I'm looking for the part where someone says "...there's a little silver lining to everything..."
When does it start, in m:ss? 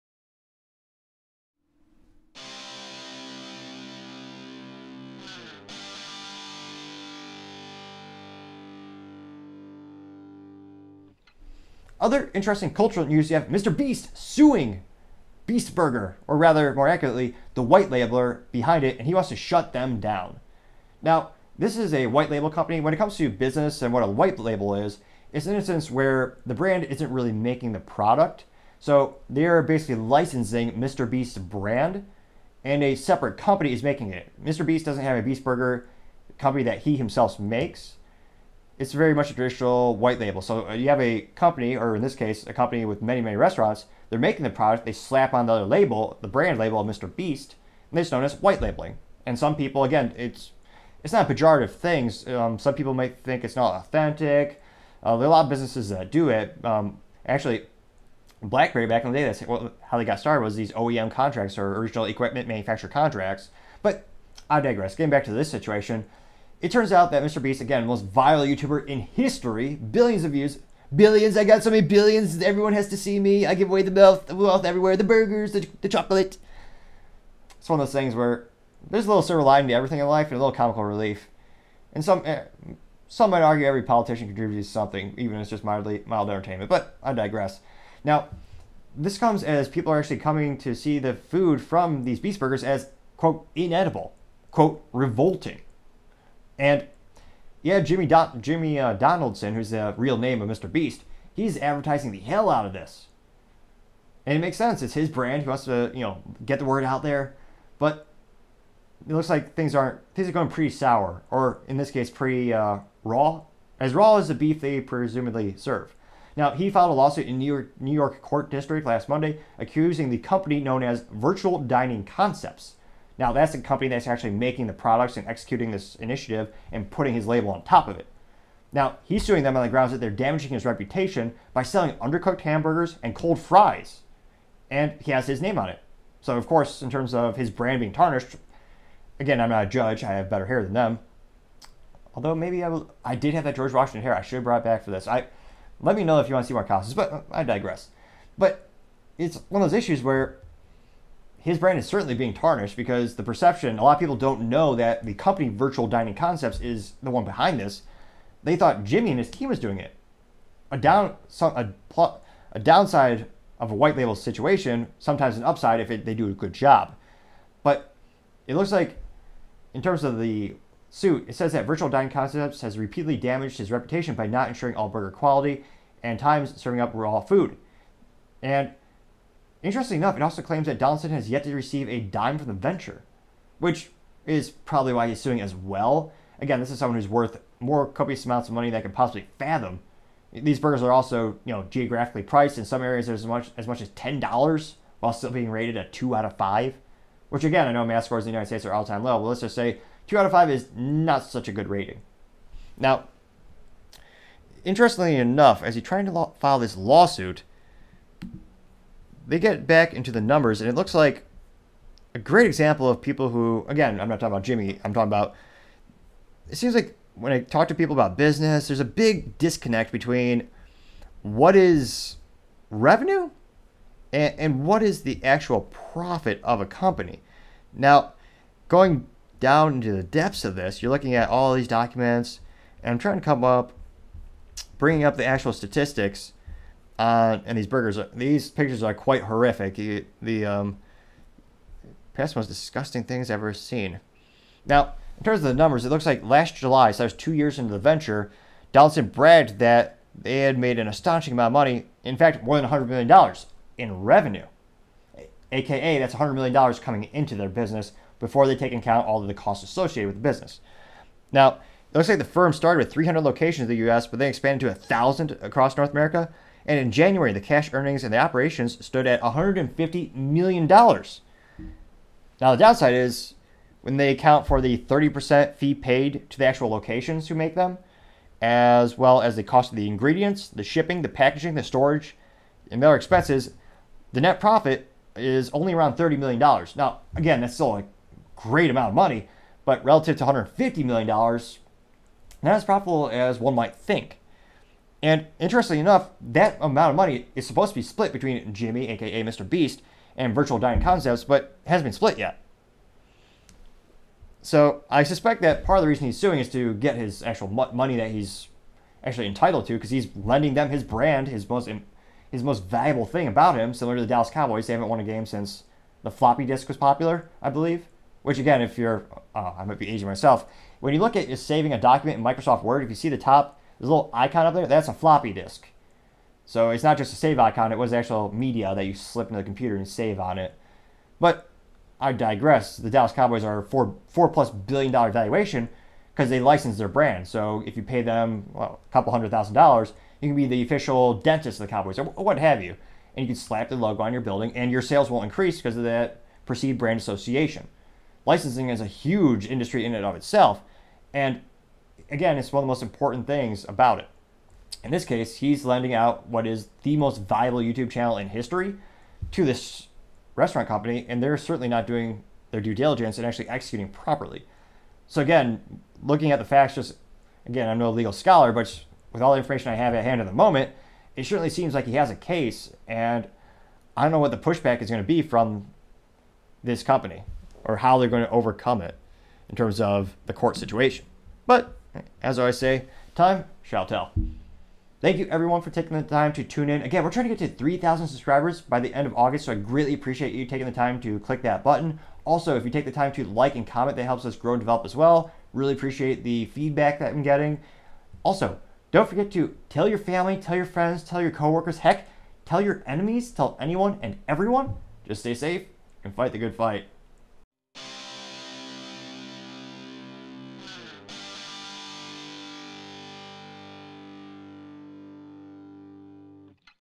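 1:18.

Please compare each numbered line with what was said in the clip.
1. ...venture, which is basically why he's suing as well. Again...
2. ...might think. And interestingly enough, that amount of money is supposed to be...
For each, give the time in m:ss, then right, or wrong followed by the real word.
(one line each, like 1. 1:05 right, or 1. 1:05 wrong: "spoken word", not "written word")
1. 3:02 wrong: "probably", not "basically"
2. 4:53 right.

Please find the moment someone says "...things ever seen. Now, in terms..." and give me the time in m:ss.
4:03.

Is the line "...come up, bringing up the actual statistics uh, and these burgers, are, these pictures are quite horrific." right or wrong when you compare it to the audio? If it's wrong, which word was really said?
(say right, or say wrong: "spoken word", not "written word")
right.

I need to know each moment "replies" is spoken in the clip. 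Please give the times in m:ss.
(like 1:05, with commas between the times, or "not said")
not said.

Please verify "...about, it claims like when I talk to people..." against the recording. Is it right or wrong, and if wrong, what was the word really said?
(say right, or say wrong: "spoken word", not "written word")
wrong: "seems", not "claims".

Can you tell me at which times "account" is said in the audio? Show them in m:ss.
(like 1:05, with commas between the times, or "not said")
4:18, 4:34.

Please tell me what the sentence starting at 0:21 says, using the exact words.
Now, this is a white label company.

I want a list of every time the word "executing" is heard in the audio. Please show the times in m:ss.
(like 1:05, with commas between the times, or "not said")
2:05, 6:03.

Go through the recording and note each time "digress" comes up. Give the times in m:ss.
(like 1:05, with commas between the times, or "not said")
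1:04, 1:27, 2:27, 5:32.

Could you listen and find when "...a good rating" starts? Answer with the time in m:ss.
3:21.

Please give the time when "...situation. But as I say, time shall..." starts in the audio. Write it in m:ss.
6:20.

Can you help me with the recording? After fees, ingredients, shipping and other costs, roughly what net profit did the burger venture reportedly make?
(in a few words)
$30 million.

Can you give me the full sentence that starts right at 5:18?
Which again, if you're, uh, I might be aging myself.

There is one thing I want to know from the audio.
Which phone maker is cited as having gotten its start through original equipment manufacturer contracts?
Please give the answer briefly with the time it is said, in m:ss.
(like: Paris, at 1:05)
BlackBerry, at 0:58.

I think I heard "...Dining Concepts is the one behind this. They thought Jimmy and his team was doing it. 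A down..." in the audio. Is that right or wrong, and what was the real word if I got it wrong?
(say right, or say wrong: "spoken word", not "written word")
right.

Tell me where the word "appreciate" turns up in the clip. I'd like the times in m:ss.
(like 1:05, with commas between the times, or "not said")
6:29, 6:35.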